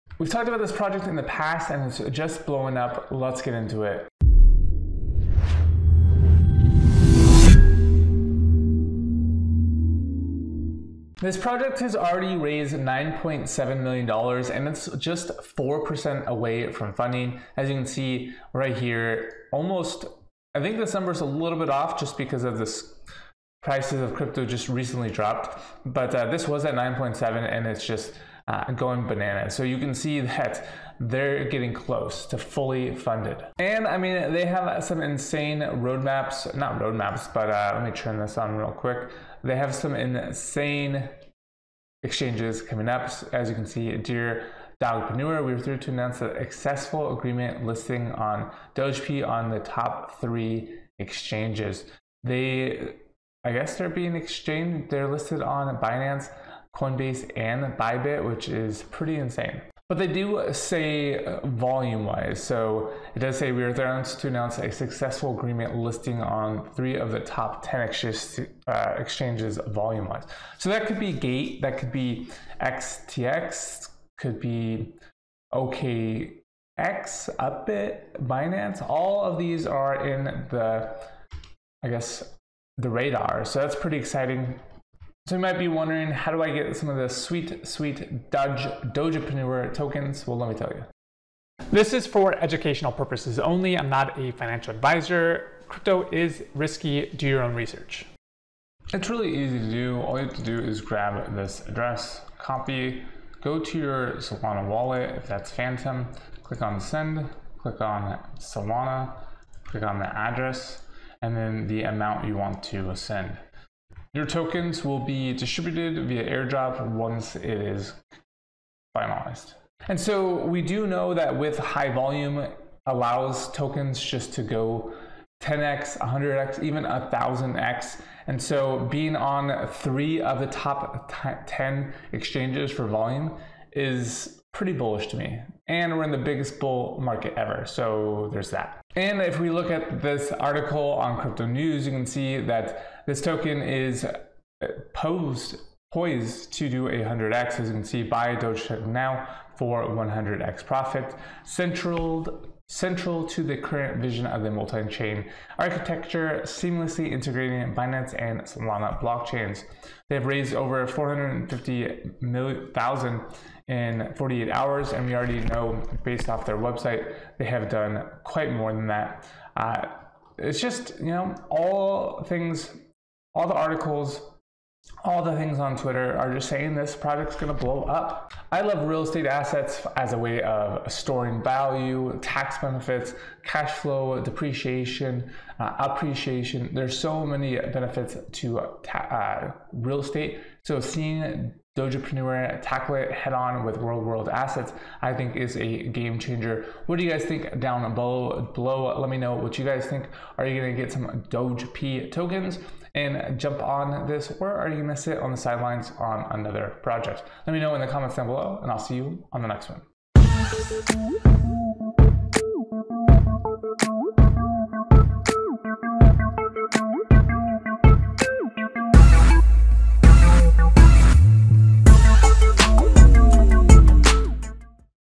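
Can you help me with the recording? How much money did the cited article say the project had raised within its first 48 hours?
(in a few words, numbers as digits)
450,000.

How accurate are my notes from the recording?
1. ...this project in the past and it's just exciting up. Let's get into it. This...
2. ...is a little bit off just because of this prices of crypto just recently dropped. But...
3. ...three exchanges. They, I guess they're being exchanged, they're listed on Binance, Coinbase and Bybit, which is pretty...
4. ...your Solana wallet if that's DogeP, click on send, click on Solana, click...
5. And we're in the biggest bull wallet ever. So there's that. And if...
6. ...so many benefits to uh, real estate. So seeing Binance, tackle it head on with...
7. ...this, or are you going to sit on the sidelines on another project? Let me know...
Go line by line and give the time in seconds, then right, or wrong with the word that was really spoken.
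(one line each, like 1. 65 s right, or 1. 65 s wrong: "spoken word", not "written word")
1. 0 s wrong: "blowing", not "exciting"
2. 21 s right
3. 50 s right
4. 103 s wrong: "Phantom", not "DogeP"
5. 135 s wrong: "market", not "wallet"
6. 186 s wrong: "Dogepreneur", not "Binance"
7. 204 s right.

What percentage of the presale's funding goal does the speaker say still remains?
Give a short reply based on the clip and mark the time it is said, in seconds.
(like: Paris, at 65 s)
4%, at 15 s.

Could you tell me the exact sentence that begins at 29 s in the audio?
So you can see that they're getting close to fully funded.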